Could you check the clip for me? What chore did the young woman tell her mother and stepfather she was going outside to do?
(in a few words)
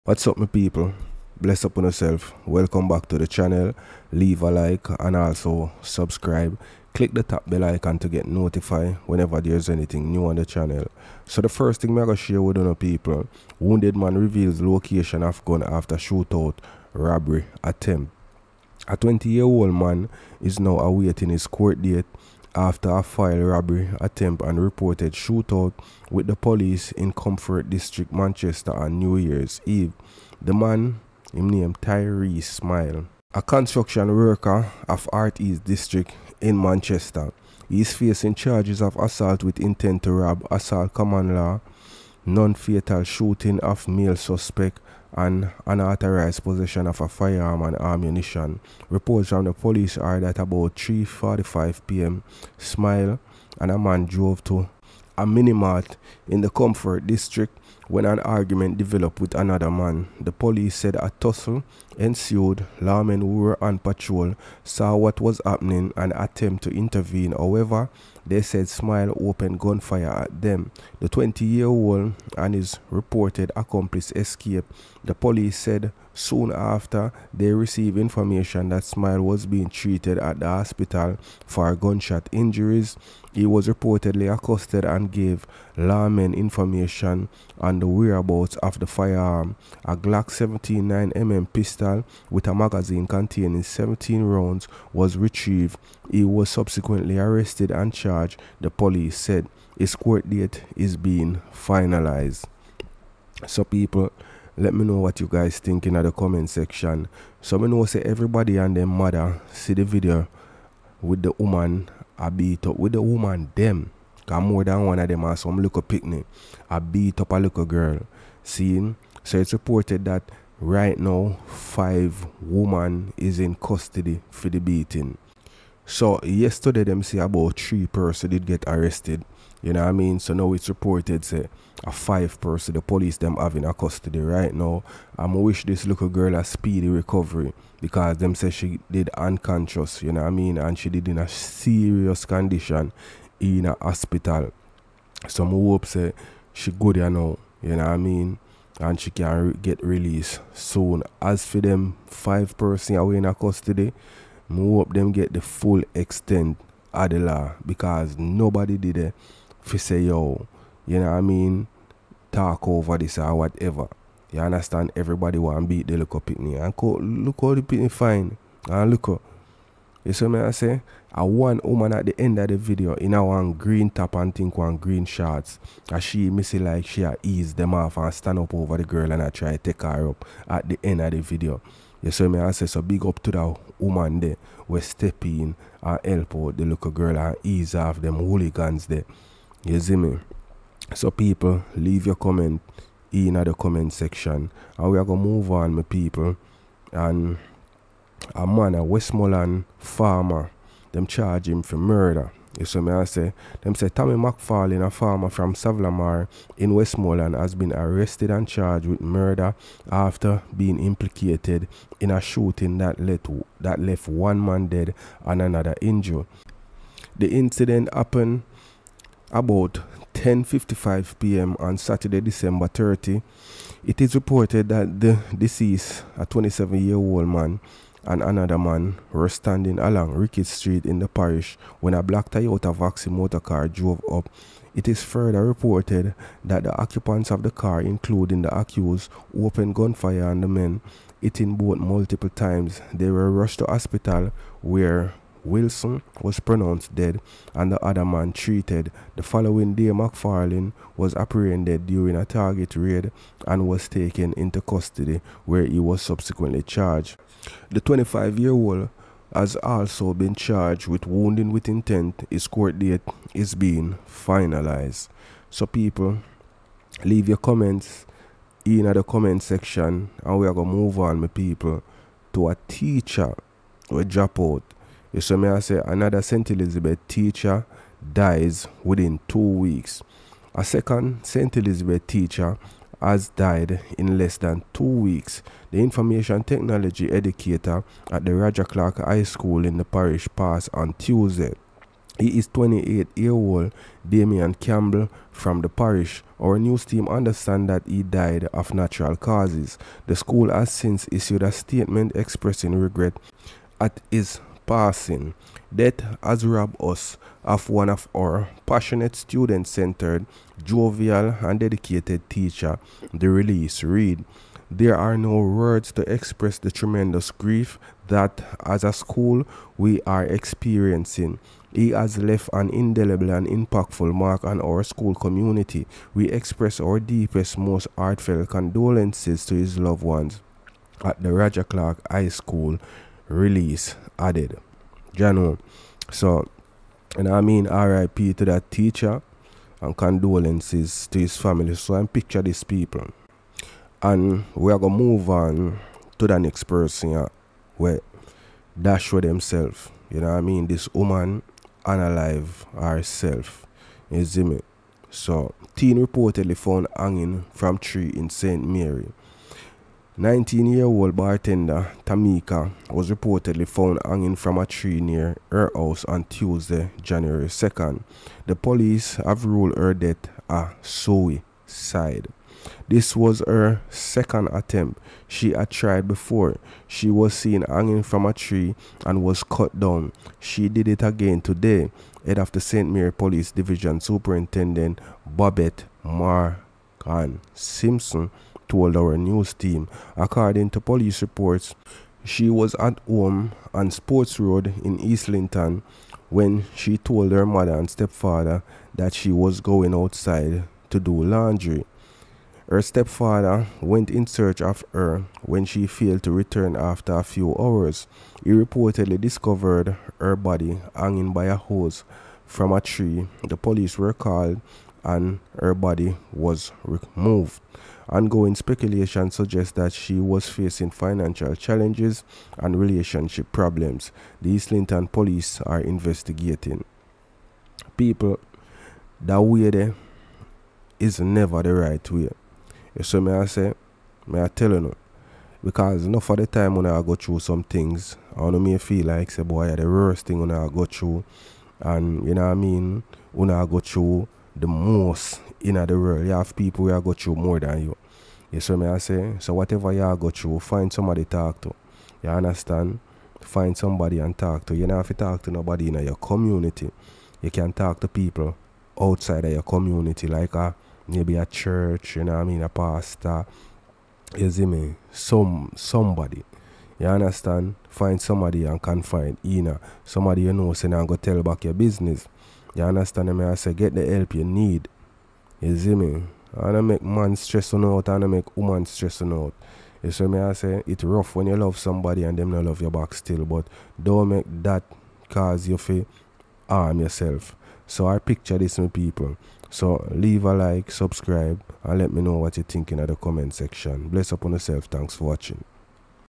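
laundry.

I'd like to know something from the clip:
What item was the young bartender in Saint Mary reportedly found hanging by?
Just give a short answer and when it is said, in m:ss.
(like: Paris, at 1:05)
a hose, at 6:51.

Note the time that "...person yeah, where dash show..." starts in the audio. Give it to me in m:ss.
5:46.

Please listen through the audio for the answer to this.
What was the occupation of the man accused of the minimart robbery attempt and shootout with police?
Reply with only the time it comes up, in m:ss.
0:33.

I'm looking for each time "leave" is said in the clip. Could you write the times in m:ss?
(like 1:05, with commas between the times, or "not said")
0:04, 3:11, 4:27, 8:10.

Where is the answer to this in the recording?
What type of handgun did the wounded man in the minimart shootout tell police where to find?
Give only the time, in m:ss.
1:29.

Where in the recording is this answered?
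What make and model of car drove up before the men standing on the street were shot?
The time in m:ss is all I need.
3:52.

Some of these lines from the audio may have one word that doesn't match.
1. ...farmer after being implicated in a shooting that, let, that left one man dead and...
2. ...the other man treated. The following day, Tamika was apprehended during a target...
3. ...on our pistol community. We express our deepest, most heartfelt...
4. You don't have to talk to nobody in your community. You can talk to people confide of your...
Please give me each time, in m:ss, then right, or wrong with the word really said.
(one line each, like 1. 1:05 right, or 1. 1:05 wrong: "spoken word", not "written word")
1. 3:28 wrong: "murder", not "farmer"
2. 4:07 wrong: "McFarlane", not "Tamika"
3. 5:24 wrong: "school", not "pistol"
4. 7:34 wrong: "outside", not "confide".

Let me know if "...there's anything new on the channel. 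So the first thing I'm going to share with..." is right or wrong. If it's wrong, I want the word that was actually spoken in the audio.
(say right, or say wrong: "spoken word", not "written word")
right.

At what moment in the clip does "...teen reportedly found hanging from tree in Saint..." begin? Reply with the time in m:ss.
5:55.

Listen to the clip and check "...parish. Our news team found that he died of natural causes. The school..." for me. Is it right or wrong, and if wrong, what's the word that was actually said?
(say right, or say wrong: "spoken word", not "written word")
wrong: "understand", not "found".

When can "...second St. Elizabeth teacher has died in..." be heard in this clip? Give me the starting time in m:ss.
4:40.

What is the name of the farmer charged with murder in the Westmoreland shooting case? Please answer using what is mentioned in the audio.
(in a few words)
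Tommy McFarlane.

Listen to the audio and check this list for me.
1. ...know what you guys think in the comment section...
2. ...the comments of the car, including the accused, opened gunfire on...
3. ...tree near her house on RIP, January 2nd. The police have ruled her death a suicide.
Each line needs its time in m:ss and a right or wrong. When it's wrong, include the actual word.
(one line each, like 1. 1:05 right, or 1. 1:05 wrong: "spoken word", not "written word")
1. 1:44 right
2. 3:56 wrong: "occupants", not "comments"
3. 6:04 wrong: "Tuesday", not "RIP".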